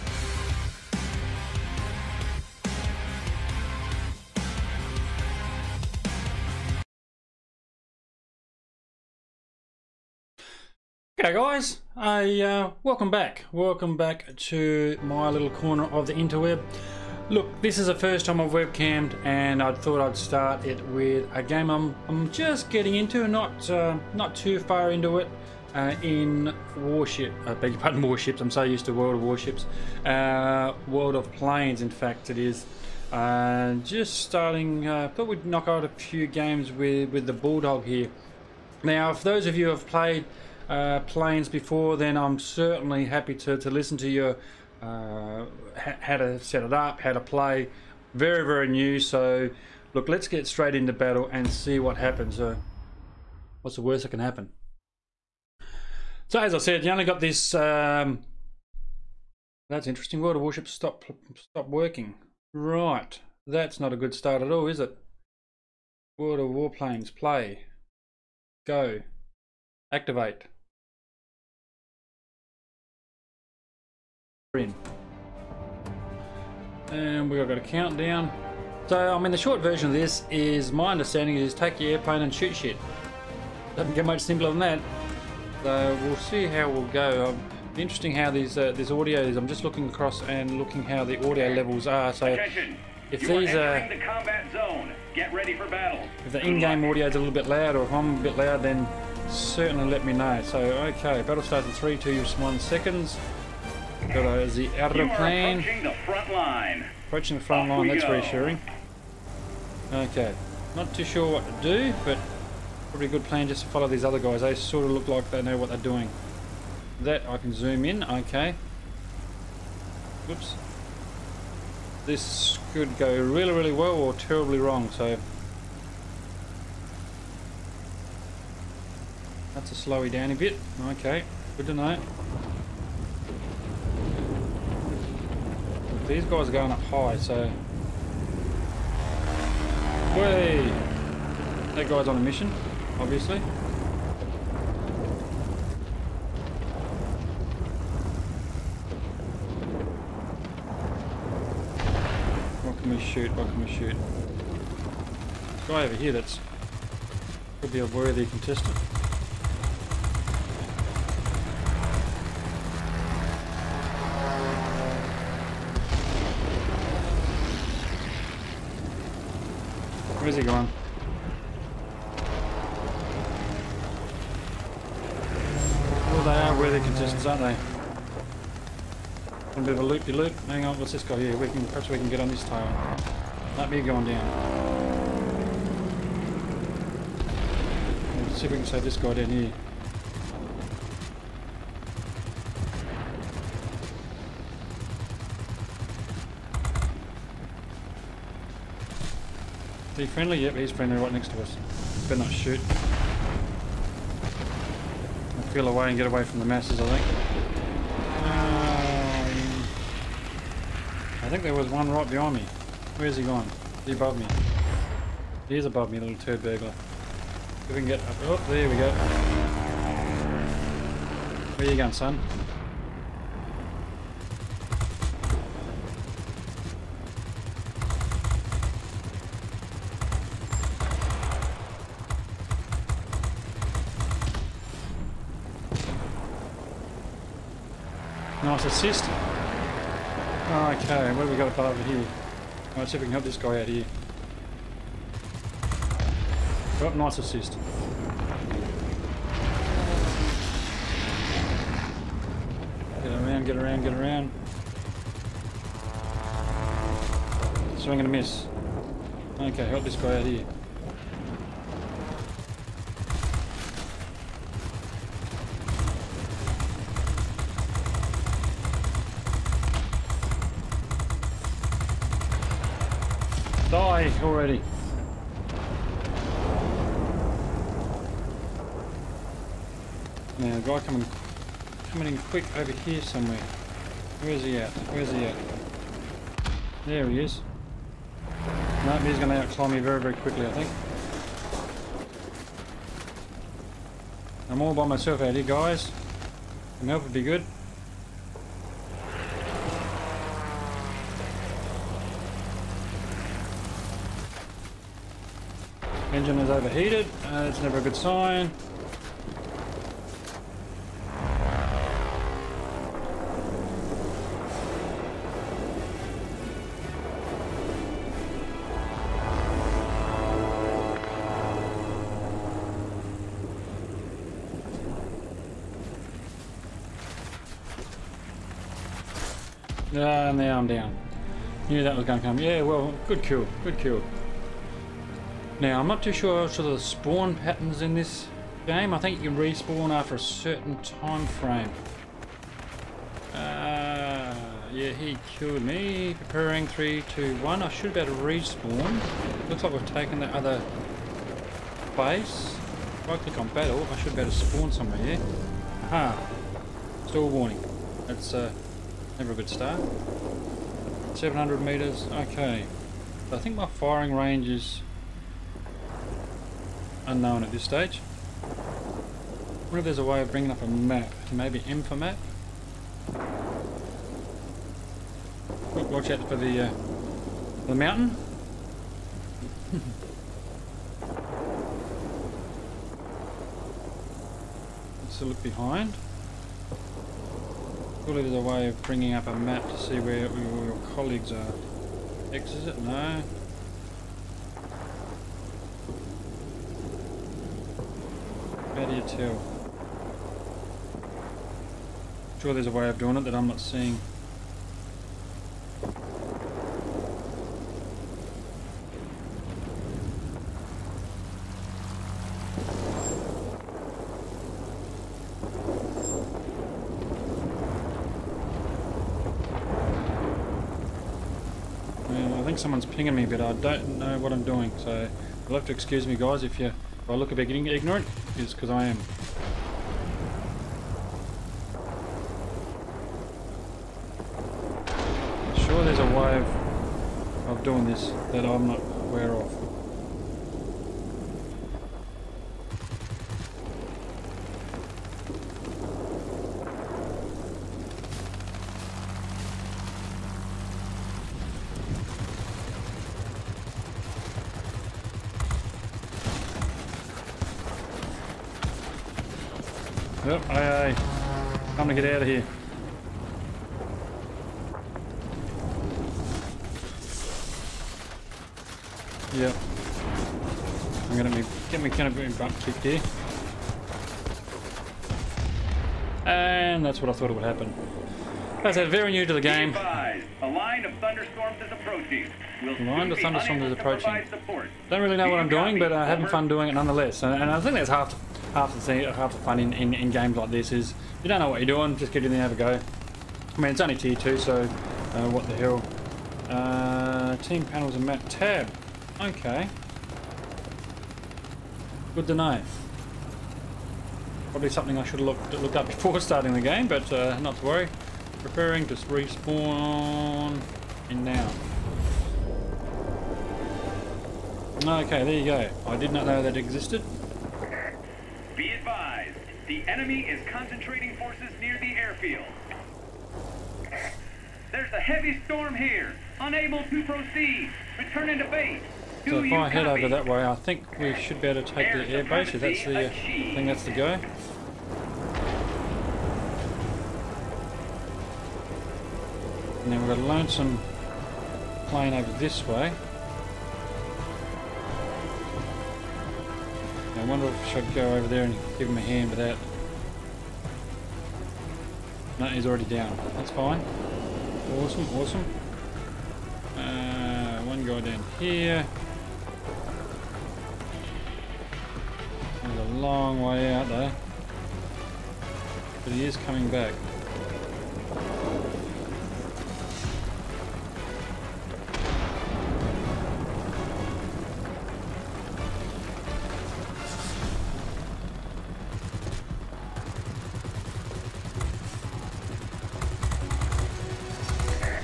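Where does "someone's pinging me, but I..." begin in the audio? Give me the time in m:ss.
7:02.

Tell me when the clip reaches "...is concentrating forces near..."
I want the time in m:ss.
8:40.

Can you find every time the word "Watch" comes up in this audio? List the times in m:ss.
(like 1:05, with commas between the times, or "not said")
6:15.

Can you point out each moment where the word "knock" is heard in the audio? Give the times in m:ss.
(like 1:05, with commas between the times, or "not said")
0:35.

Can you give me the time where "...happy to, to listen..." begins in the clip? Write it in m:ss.
0:43.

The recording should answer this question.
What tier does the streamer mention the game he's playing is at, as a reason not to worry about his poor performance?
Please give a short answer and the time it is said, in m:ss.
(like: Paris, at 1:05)
Tier 2, at 8:13.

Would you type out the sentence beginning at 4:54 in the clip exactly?
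I'm all by myself out here, guys.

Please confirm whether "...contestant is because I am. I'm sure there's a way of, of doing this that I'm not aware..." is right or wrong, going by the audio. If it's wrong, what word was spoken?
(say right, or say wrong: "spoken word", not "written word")
wrong: "ignorant", not "contestant".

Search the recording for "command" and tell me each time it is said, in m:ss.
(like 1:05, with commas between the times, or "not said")
not said.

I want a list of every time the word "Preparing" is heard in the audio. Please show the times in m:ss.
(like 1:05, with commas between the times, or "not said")
5:46, 8:28.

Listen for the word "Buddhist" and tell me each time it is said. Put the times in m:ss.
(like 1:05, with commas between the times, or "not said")
not said.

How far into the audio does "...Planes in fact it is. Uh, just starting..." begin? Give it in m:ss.
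0:31.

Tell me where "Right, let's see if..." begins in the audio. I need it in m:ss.
4:01.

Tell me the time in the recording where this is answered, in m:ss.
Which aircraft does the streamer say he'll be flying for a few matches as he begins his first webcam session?
0:37.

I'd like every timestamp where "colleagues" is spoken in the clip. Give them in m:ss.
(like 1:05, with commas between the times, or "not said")
6:30.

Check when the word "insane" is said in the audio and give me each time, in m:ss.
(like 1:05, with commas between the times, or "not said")
not said.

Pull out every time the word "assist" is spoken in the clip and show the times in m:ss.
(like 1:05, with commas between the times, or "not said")
3:58, 4:07.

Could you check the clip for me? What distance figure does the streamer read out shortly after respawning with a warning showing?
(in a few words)
700 meters.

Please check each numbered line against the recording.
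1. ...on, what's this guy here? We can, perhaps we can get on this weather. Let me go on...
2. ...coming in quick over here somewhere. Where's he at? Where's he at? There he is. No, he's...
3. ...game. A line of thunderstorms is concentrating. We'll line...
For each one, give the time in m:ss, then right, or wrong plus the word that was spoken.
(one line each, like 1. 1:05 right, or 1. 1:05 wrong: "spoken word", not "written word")
1. 3:00 wrong: "tower", not "weather"
2. 4:41 right
3. 7:59 wrong: "approaching", not "concentrating".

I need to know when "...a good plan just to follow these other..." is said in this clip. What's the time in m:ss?
1:53.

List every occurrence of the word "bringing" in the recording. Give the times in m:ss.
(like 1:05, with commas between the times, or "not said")
6:10, 6:28.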